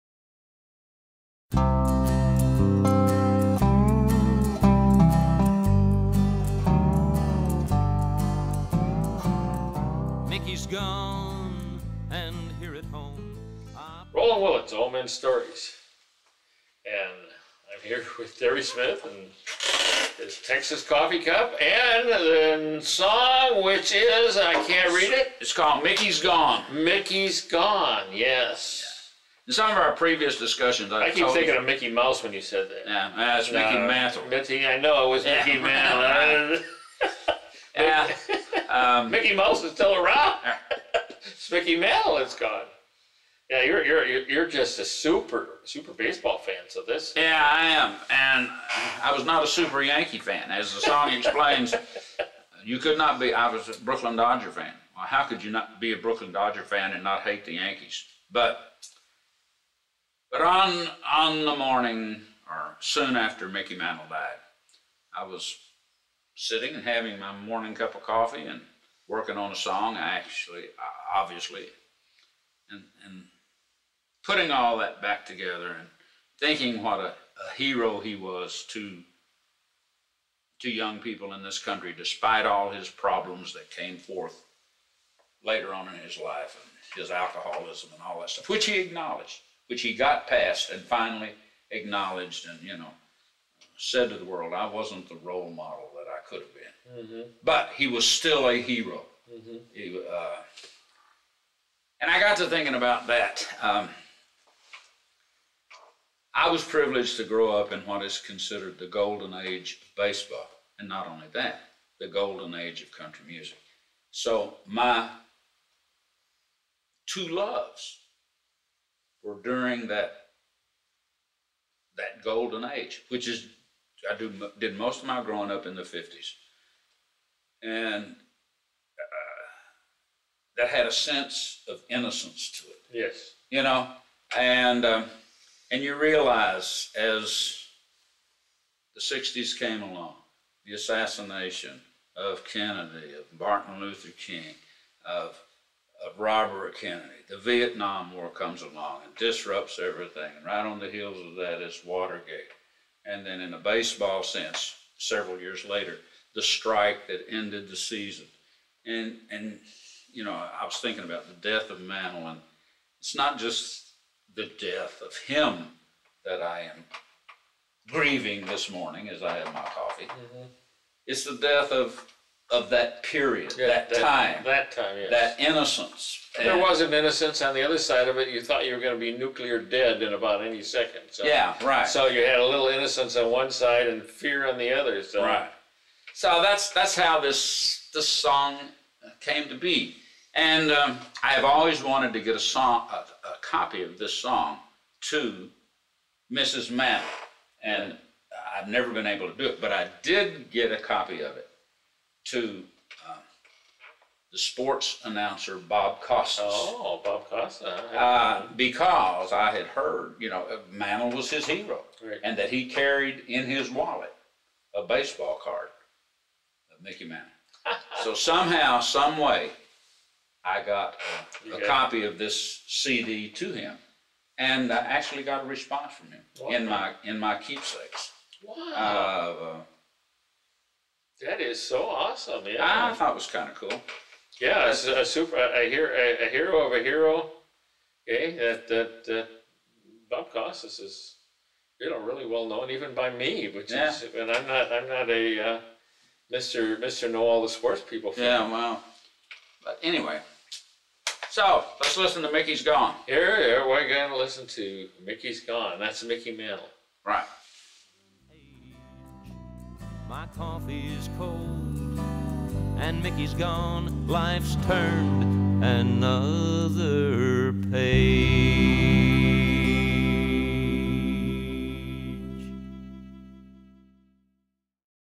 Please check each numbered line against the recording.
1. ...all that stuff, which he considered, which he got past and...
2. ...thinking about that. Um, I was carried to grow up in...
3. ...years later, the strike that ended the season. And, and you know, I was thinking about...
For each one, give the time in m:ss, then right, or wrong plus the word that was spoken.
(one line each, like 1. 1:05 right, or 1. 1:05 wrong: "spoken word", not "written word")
1. 1:28 wrong: "acknowledged", not "considered"
2. 1:42 wrong: "privileged", not "carried"
3. 2:35 right.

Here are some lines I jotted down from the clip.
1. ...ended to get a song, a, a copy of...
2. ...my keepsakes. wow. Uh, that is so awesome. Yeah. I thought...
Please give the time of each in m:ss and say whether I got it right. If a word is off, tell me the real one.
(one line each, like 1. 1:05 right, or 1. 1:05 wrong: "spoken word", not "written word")
1. 3:11 wrong: "wanted", not "ended"
2. 3:47 right.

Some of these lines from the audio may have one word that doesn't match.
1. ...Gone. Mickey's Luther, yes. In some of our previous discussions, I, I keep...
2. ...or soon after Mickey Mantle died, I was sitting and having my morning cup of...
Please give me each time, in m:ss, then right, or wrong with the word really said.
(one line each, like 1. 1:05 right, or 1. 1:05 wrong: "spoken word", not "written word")
1. 0:26 wrong: "Gone", not "Luther"
2. 1:02 right.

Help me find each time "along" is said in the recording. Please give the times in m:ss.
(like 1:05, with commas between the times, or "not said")
2:19, 2:28.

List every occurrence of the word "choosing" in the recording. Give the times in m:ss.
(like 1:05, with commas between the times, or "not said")
not said.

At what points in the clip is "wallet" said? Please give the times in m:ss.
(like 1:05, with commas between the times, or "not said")
3:33.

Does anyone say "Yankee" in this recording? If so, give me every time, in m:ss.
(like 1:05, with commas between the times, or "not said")
0:49, 0:57.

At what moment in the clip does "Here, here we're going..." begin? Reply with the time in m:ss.
4:13.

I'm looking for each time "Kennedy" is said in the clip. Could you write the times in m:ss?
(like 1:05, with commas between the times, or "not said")
2:22, 2:26.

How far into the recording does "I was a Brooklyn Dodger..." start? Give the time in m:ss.
0:53.